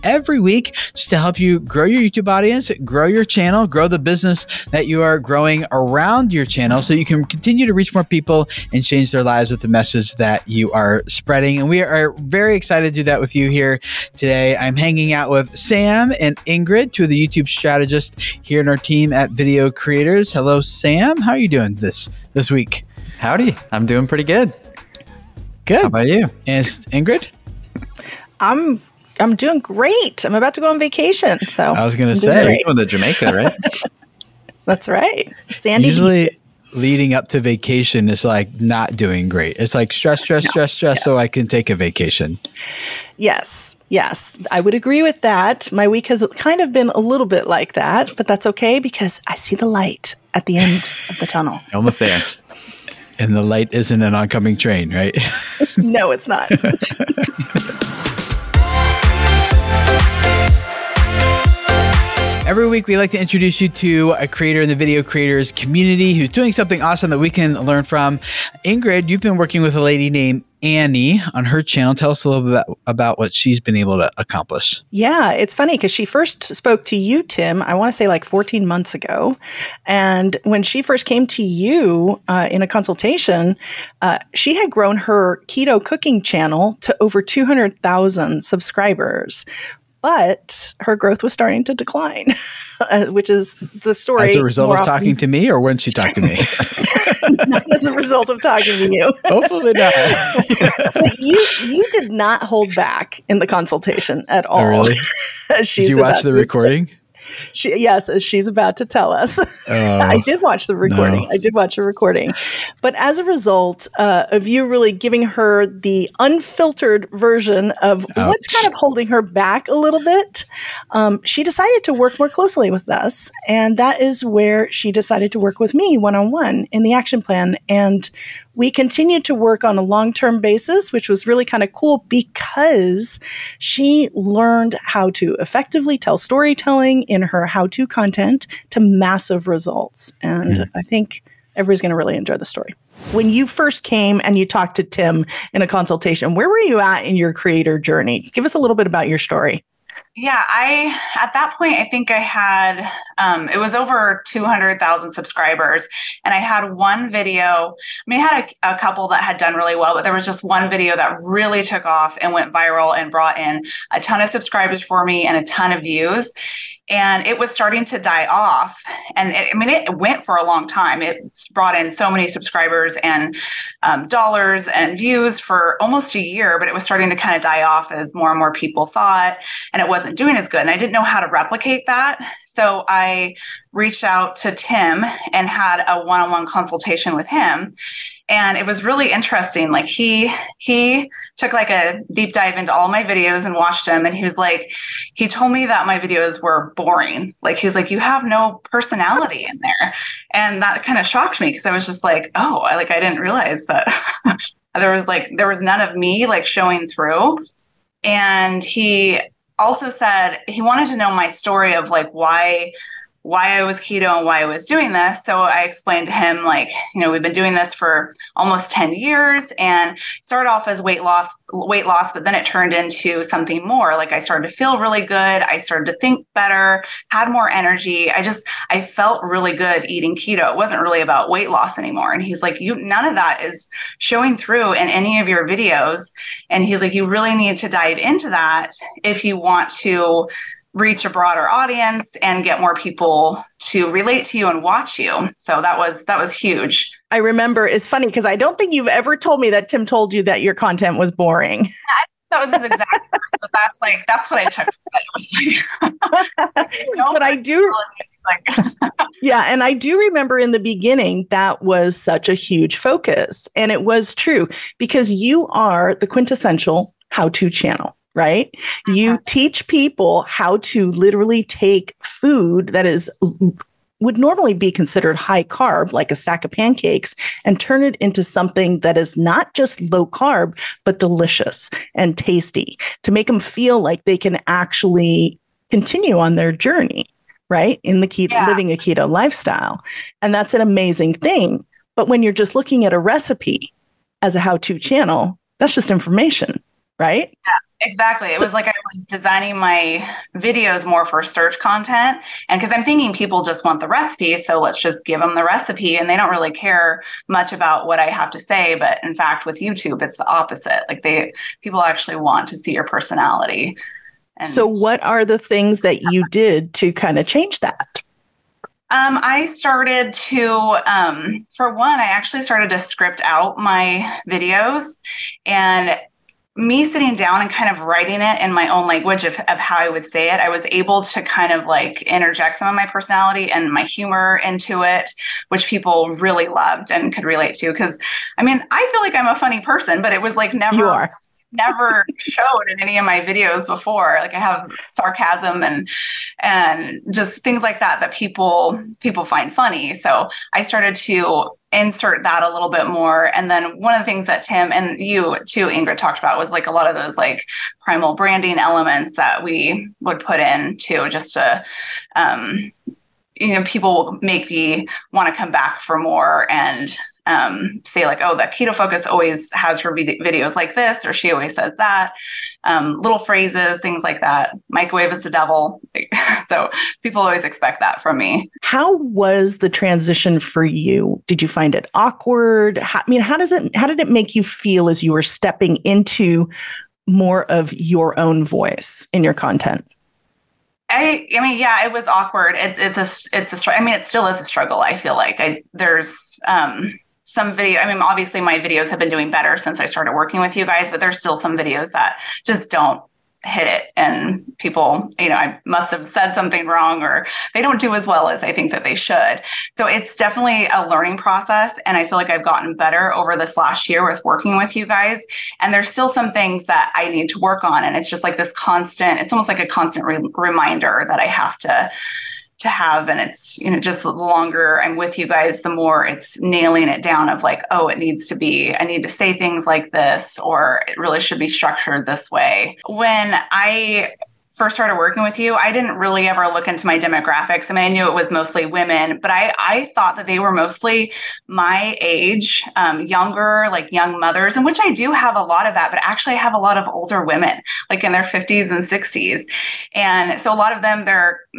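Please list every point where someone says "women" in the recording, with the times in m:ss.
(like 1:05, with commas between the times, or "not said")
7:18, 7:27.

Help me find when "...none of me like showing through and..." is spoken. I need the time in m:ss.
3:25.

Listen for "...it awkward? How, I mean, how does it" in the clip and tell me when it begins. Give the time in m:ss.
6:21.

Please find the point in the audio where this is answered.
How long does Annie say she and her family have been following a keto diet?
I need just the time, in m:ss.
3:38.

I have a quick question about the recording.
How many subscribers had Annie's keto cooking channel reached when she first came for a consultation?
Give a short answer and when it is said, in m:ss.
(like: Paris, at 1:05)
Over 200,000, at 1:27.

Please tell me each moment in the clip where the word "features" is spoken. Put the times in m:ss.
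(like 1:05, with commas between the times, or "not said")
not said.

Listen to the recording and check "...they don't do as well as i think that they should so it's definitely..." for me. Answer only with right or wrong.
right.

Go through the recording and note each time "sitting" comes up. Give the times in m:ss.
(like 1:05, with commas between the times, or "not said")
5:26.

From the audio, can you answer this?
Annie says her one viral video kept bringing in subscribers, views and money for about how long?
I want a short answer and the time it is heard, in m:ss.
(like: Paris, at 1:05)
Almost a year, at 2:55.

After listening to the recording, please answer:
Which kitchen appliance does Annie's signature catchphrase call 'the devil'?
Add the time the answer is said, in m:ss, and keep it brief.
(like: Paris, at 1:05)
Microwave, at 6:14.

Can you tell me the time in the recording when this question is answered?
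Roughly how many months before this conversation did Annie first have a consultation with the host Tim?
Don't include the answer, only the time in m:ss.
1:18.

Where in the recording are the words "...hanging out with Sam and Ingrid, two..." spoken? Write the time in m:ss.
0:14.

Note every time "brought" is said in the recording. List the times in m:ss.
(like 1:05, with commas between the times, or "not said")
2:43, 2:51.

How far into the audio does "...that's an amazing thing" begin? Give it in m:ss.
4:50.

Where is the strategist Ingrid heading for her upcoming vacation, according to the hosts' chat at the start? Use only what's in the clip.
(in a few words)
Jamaica.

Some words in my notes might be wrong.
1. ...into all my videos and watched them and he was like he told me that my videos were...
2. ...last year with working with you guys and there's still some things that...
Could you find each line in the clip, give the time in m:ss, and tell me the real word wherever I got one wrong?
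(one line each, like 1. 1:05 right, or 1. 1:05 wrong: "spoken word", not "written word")
1. 3:12 right
2. 6:53 right.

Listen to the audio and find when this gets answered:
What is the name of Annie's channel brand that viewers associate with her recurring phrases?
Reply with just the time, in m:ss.
6:08.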